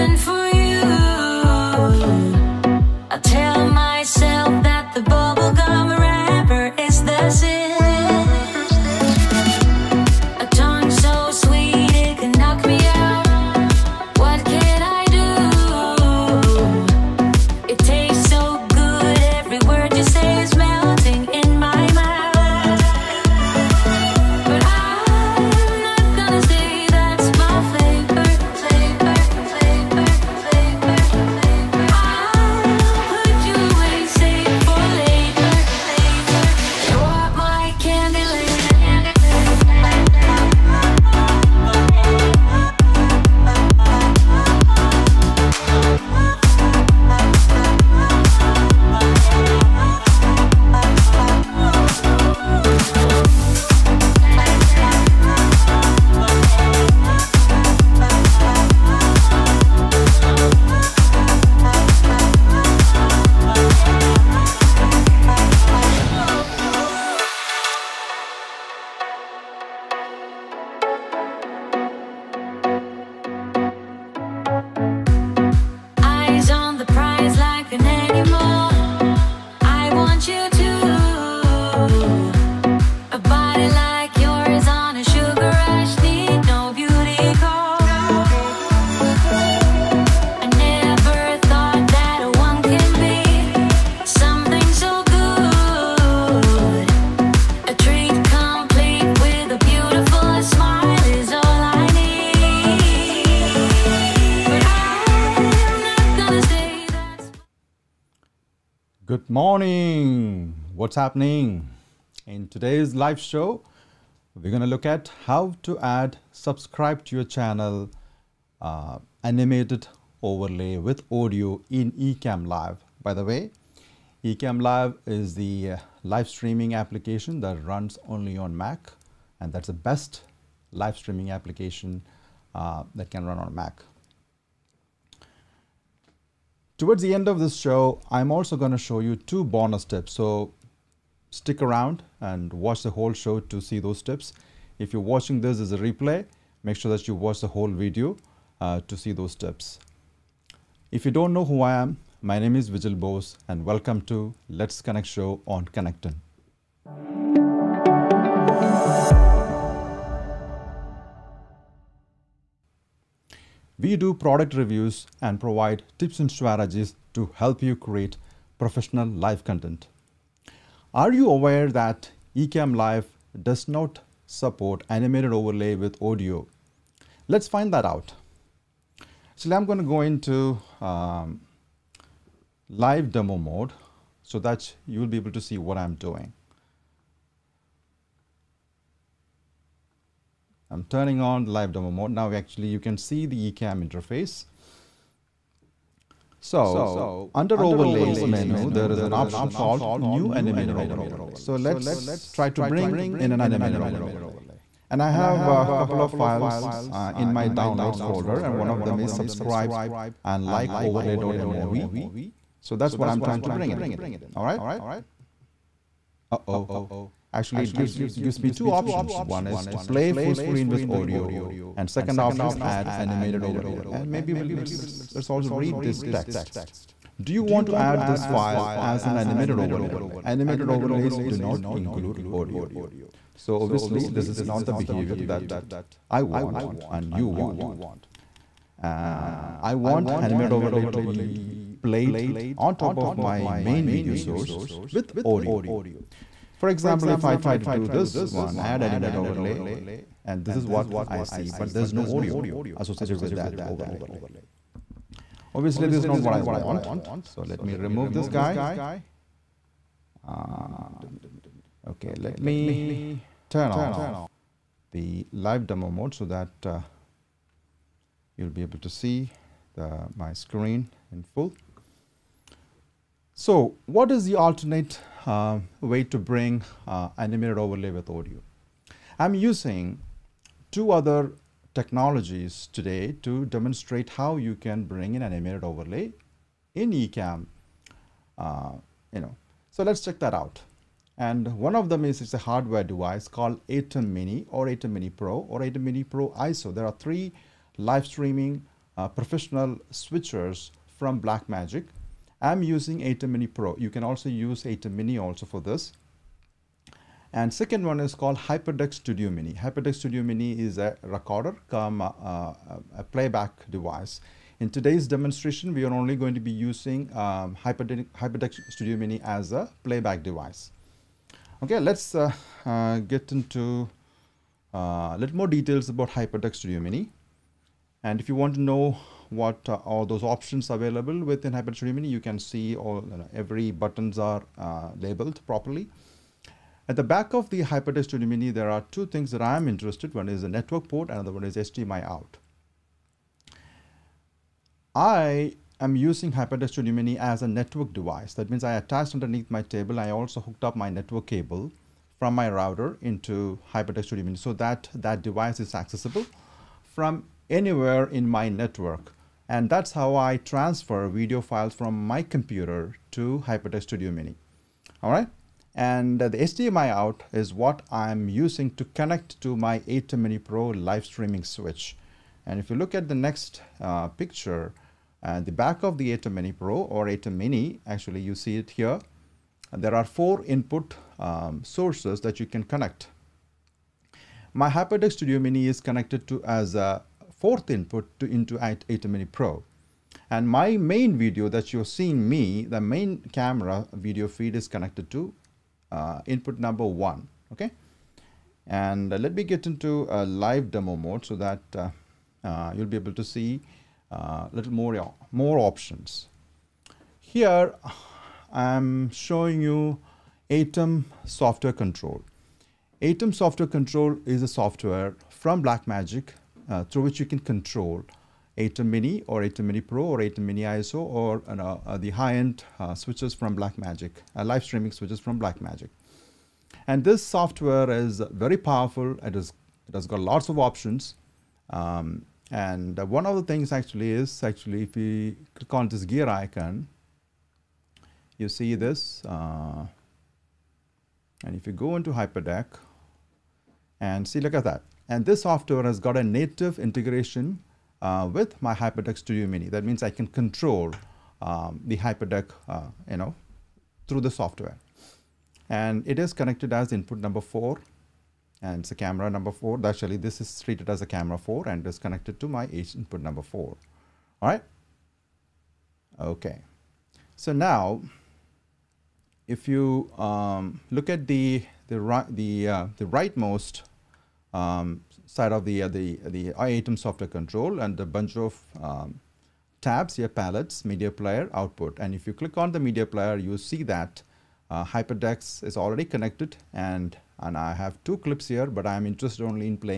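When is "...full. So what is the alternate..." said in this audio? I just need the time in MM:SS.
04:31.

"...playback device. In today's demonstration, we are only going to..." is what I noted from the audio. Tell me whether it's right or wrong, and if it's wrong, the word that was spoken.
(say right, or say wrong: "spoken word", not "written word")
right.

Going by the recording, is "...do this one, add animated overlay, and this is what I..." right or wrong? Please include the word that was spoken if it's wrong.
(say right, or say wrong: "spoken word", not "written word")
right.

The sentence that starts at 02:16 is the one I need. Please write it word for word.
Towards the end of this show, I'm also going to show you two bonus tips.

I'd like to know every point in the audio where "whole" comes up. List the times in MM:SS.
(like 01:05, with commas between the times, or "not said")
02:22, 02:27.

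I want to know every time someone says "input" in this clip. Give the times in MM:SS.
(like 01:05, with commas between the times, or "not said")
06:20, 06:27, 06:36, 07:36, 07:42.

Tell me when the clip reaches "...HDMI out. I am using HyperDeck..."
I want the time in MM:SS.
05:41.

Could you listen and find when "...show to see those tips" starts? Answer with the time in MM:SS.
02:23.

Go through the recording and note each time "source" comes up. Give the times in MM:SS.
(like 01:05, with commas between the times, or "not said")
04:04, 06:21.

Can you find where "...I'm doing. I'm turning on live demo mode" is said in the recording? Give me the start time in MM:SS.
03:05.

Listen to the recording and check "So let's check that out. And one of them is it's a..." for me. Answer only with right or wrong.
right.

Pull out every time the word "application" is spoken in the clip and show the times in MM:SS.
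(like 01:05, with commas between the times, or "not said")
02:06, 02:11.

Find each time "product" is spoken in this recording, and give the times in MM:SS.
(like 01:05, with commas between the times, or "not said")
02:44.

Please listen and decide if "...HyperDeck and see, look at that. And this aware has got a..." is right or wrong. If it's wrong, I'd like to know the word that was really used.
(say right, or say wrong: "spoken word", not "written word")
wrong: "software", not "aware".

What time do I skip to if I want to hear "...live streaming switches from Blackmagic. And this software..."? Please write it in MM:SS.
07:04.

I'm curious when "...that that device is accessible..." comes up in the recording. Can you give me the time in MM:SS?
05:54.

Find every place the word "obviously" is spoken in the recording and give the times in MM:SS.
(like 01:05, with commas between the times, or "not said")
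03:53, 04:15.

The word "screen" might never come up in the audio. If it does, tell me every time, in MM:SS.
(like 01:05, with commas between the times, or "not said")
03:40, 04:30.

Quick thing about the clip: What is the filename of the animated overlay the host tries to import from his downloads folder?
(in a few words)
subscribe and like overlay.mov.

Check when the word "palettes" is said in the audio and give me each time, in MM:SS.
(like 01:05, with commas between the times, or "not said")
08:00.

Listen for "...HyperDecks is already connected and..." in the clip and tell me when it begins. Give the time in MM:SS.
08:04.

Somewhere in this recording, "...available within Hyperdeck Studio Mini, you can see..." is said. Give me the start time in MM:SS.
05:30.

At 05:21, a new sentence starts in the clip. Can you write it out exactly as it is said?
Okay, let's uh, uh, get into uh, a little more details about Hyperdeck Studio Mini.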